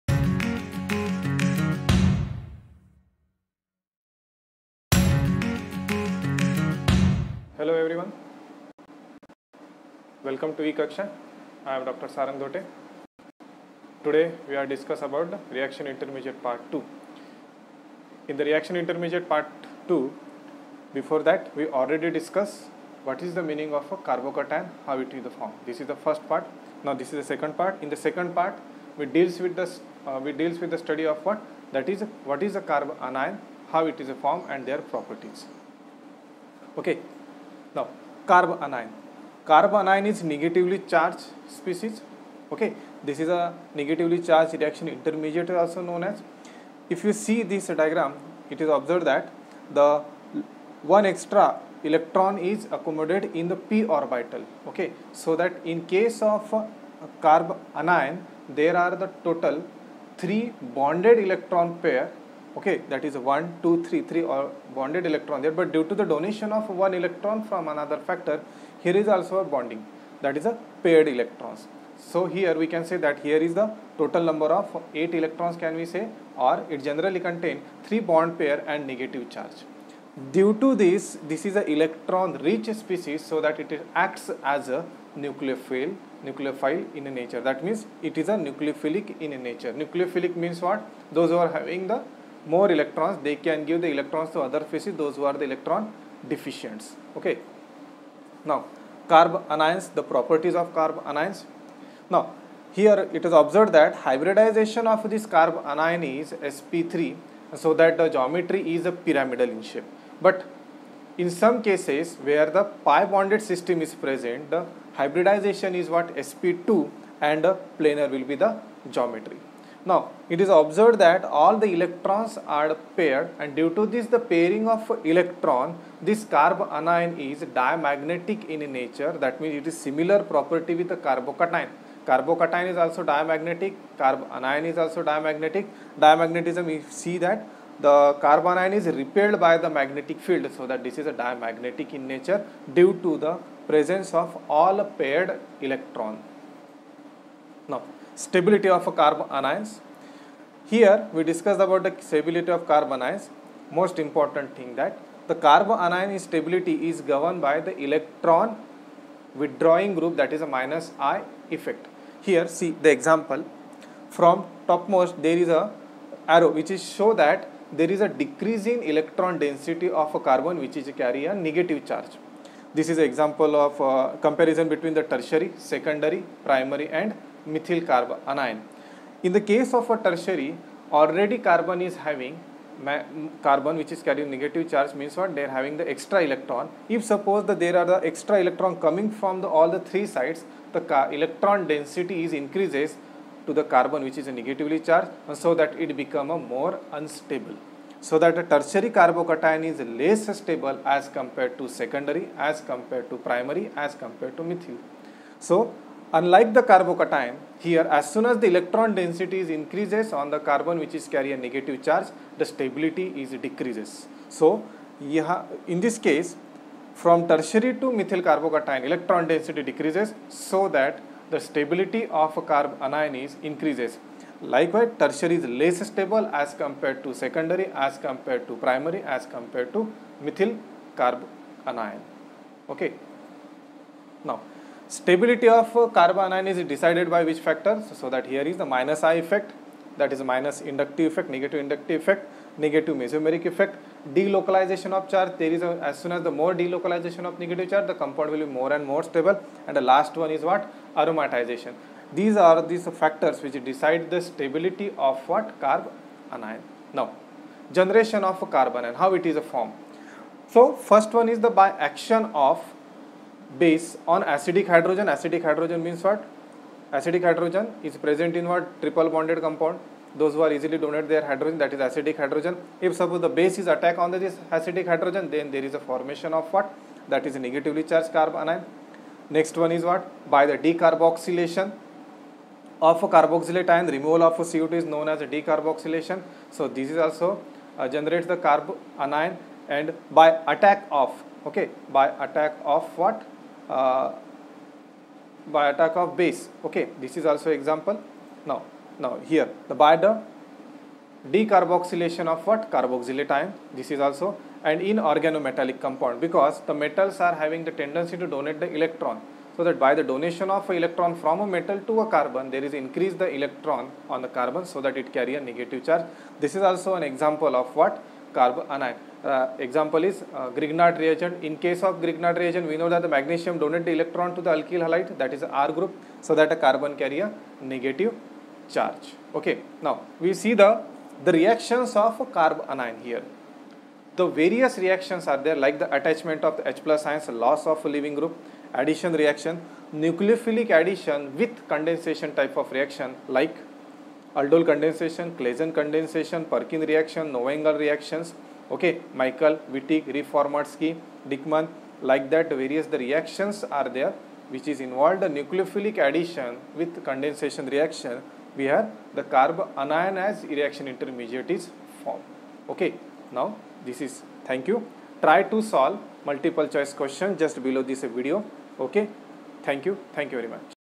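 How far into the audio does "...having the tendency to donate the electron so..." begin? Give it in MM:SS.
05:07.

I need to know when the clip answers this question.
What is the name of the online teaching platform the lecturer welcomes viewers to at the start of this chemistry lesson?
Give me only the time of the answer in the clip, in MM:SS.
00:10.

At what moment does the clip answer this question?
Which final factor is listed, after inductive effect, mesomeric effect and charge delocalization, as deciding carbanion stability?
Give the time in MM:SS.
04:10.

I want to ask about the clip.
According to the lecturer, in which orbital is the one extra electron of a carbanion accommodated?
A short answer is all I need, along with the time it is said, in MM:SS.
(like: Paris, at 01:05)
p orbital, at 00:53.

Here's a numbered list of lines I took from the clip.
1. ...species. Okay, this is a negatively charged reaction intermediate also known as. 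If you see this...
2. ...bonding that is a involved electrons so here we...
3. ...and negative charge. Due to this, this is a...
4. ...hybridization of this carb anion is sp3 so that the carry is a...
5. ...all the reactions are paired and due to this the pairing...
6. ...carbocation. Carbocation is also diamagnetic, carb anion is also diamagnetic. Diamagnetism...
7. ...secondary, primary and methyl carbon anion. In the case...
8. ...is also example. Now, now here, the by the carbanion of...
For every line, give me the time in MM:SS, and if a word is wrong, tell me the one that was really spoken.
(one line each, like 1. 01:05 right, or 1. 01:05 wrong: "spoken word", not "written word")
1. 00:41 right
2. 01:09 wrong: "paired", not "involved"
3. 01:18 right
4. 01:44 wrong: "geometry", not "carry"
5. 02:01 wrong: "electrons", not "reactions"
6. 02:10 right
7. 02:55 right
8. 04:57 wrong: "decarboxylation", not "carbanion".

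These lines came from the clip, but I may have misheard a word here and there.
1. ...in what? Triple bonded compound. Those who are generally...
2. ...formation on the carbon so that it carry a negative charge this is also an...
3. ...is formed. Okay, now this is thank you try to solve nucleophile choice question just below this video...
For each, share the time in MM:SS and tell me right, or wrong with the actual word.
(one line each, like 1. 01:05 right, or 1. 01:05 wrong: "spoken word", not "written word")
1. 04:28 wrong: "easily", not "generally"
2. 05:13 wrong: "electron", not "formation"
3. 06:01 wrong: "multiple", not "nucleophile".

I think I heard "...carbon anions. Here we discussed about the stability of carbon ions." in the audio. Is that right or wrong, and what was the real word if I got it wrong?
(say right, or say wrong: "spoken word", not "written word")
right.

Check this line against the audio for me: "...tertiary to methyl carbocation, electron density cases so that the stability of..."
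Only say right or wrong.
wrong.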